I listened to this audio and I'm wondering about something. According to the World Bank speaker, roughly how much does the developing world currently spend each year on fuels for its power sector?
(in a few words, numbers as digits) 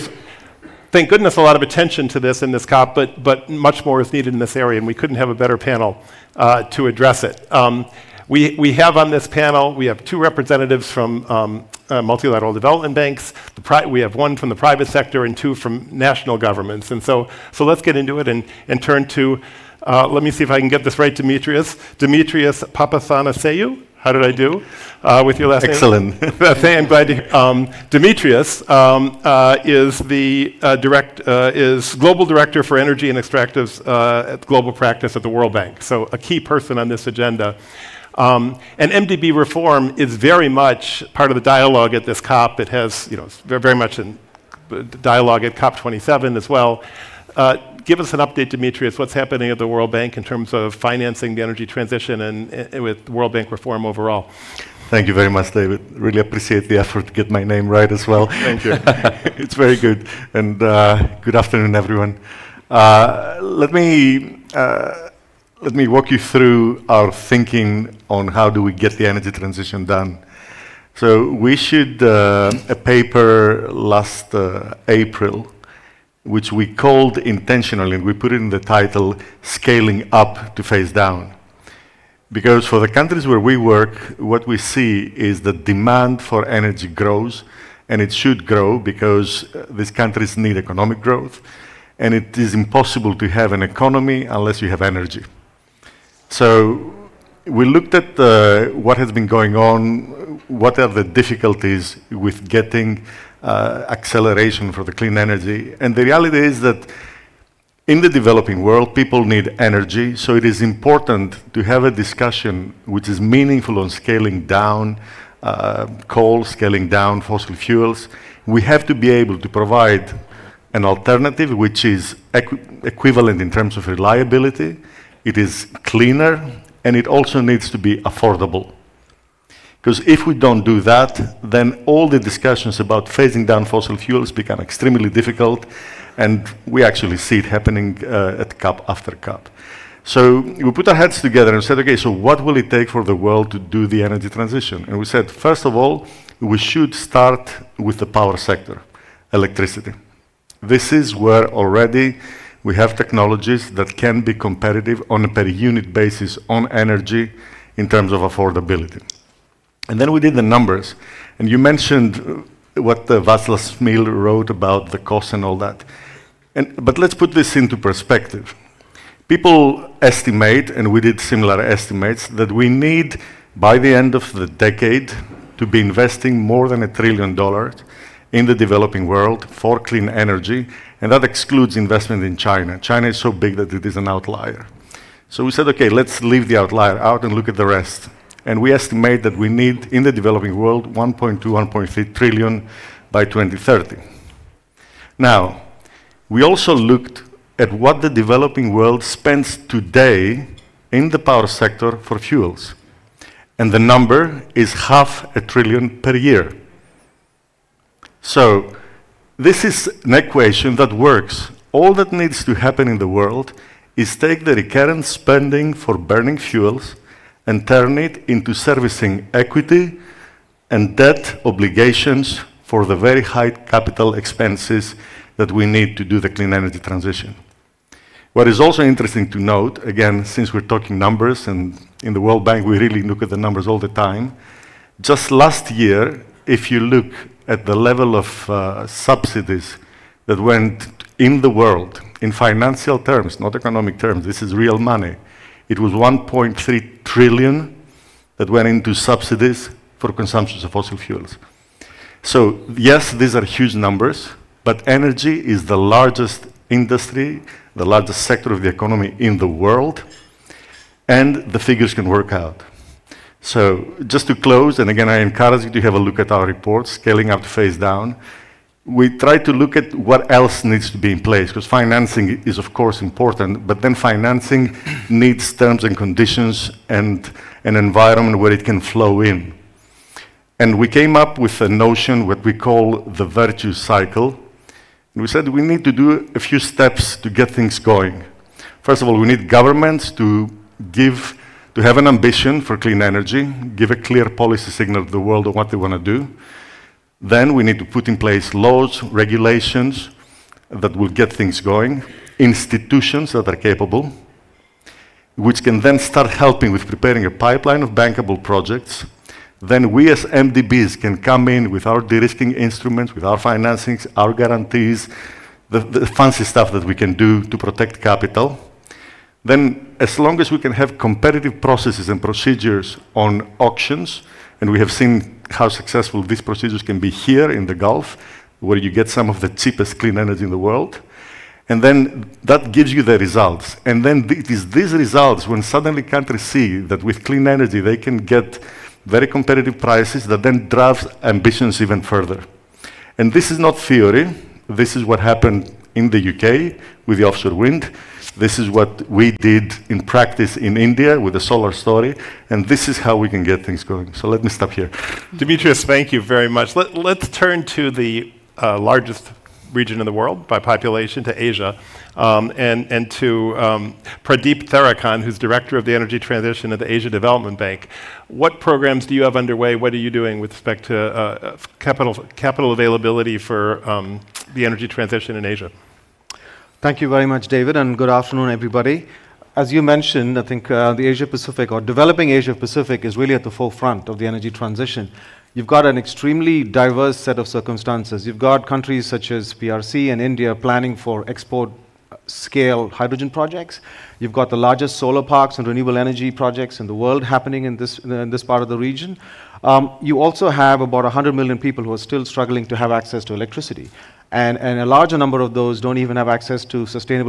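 half a trillion.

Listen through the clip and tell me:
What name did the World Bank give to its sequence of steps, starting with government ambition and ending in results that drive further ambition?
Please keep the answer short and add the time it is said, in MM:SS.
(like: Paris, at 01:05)
virtue cycle, at 04:43.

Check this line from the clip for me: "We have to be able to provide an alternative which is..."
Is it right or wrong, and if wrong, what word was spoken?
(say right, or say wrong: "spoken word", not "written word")
right.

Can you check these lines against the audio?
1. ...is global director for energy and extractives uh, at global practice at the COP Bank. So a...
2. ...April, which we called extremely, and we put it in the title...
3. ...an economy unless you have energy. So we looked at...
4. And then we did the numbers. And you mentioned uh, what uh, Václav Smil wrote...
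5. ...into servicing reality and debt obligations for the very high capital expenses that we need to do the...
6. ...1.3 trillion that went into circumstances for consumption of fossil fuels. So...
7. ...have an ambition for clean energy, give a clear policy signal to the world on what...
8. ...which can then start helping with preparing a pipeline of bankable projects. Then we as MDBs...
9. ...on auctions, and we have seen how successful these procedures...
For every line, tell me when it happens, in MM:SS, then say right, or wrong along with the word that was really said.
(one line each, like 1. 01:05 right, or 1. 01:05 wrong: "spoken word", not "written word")
1. 00:31 wrong: "World", not "COP"
2. 01:14 wrong: "intentionally", not "extremely"
3. 01:33 right
4. 02:39 right
5. 03:38 wrong: "equity", not "reality"
6. 04:05 wrong: "subsidies", not "circumstances"
7. 04:51 right
8. 05:05 right
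9. 05:23 right.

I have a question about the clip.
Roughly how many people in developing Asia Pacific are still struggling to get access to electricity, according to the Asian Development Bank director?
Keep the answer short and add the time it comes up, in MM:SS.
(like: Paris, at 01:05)
100 million, at 06:41.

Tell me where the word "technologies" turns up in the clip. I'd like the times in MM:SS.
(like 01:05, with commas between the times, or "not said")
02:32.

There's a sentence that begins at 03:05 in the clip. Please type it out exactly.
So we said, okay, let's leave the outlier out and look at the rest.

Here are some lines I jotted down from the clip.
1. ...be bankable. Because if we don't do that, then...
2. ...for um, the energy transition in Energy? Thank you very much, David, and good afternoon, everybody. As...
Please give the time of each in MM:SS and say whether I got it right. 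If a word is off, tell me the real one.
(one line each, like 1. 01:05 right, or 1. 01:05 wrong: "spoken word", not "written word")
1. 02:07 wrong: "affordable", not "bankable"
2. 06:13 wrong: "Asia", not "Energy".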